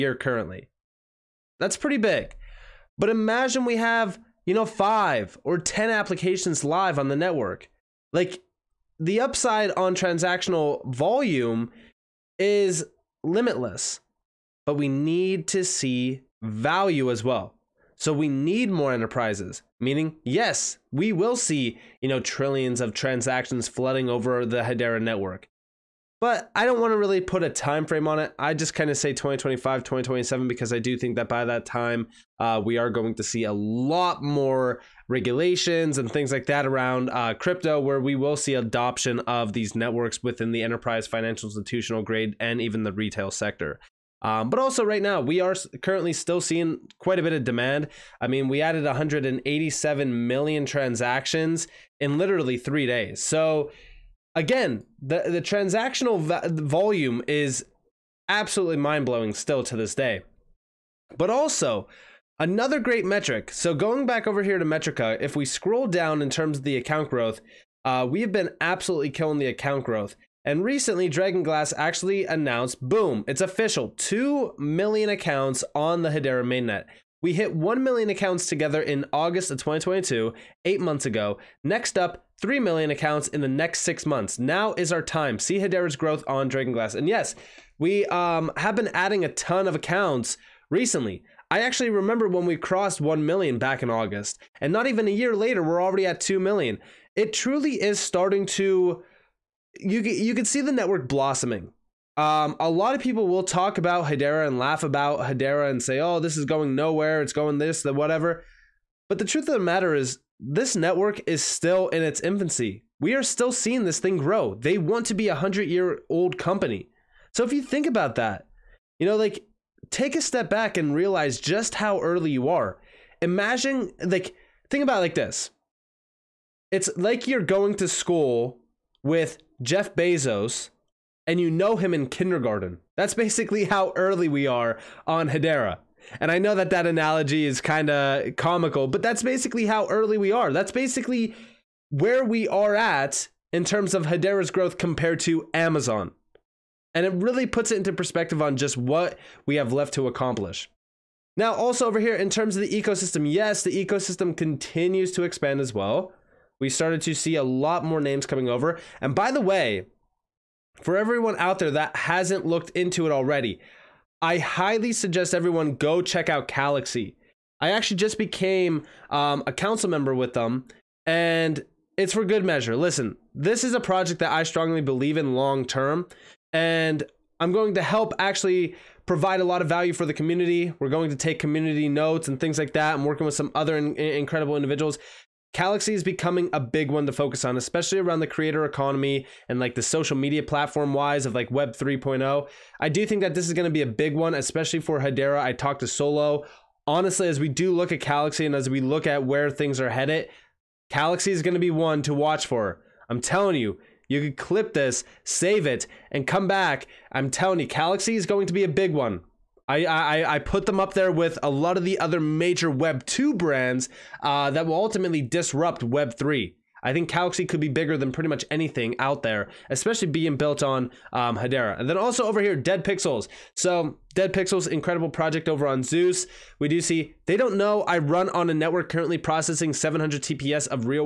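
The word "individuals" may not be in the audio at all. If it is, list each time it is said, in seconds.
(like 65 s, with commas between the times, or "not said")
184 s.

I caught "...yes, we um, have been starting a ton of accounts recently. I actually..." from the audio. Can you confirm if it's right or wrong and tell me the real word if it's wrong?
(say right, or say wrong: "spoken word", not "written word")
wrong: "adding", not "starting".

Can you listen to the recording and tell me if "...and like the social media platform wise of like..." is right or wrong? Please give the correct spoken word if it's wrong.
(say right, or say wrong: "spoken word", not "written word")
right.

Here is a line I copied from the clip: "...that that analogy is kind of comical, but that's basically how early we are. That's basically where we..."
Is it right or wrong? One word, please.
right.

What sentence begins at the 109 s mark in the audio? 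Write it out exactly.
But the truth of the matter is, this network is still in its infancy.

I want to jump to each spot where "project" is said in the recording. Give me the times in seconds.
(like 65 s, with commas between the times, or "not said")
173 s, 225 s.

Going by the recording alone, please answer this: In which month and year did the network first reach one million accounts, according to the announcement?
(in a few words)
August 2022.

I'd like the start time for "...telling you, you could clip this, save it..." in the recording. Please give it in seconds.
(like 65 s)
203 s.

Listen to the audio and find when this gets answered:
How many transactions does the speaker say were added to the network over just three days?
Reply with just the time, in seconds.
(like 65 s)
48 s.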